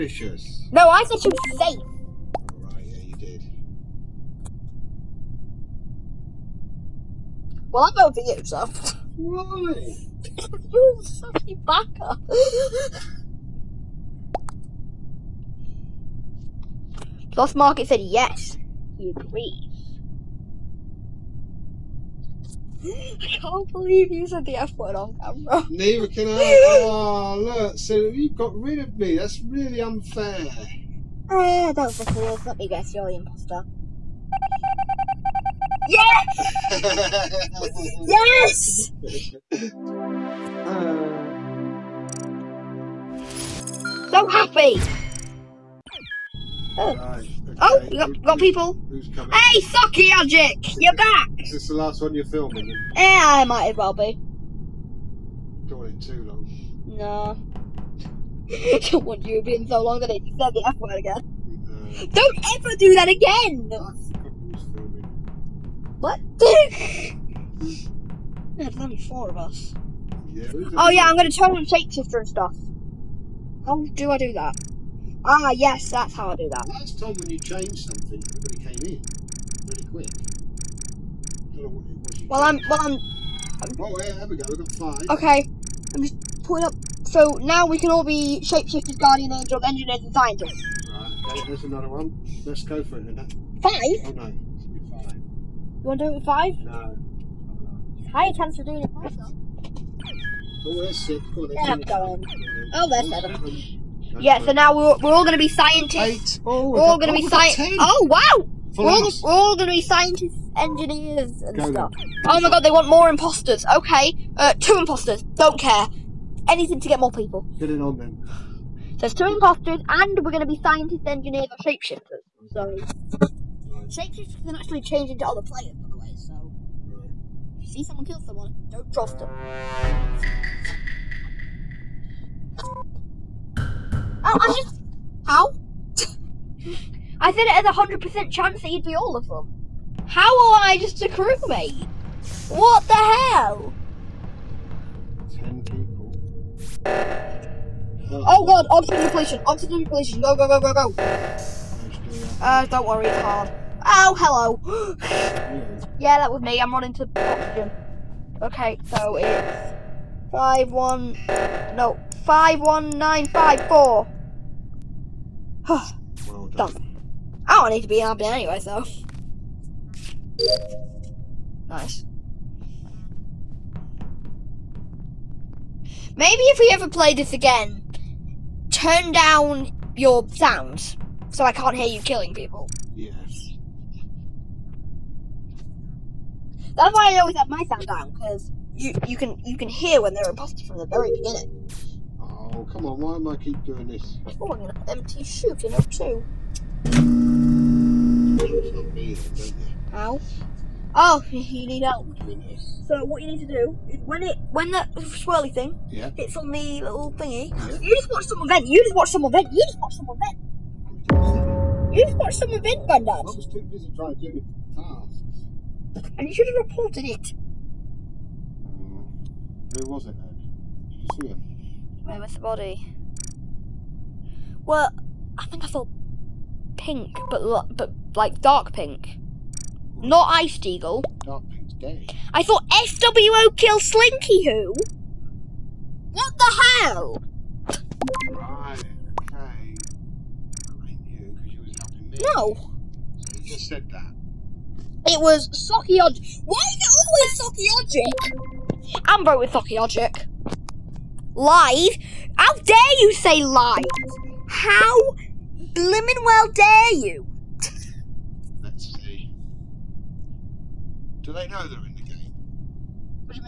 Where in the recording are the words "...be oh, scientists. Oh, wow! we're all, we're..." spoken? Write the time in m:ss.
1:47.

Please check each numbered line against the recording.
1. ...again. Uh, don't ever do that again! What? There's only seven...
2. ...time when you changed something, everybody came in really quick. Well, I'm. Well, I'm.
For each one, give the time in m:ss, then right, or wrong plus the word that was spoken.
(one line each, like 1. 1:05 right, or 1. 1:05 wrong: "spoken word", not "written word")
1. 1:00 wrong: "four", not "seven"
2. 1:16 right.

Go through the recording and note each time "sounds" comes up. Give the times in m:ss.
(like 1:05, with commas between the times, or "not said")
3:00, 3:07.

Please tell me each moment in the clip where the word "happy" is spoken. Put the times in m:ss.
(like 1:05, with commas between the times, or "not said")
0:44, 2:47.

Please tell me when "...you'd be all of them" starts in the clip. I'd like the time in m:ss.
2:18.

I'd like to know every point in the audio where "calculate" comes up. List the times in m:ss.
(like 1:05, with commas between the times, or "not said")
not said.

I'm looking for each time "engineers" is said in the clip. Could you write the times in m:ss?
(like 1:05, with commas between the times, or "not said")
1:29, 1:50, 2:01.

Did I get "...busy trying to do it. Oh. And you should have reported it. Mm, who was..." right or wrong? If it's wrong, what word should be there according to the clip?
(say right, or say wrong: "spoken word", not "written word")
right.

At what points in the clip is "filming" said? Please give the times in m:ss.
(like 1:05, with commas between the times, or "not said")
0:52.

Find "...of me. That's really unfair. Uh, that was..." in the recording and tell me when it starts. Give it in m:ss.
0:28.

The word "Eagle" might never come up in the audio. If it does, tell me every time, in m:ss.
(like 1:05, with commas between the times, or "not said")
3:50.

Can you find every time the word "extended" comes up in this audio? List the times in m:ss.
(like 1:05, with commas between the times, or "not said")
not said.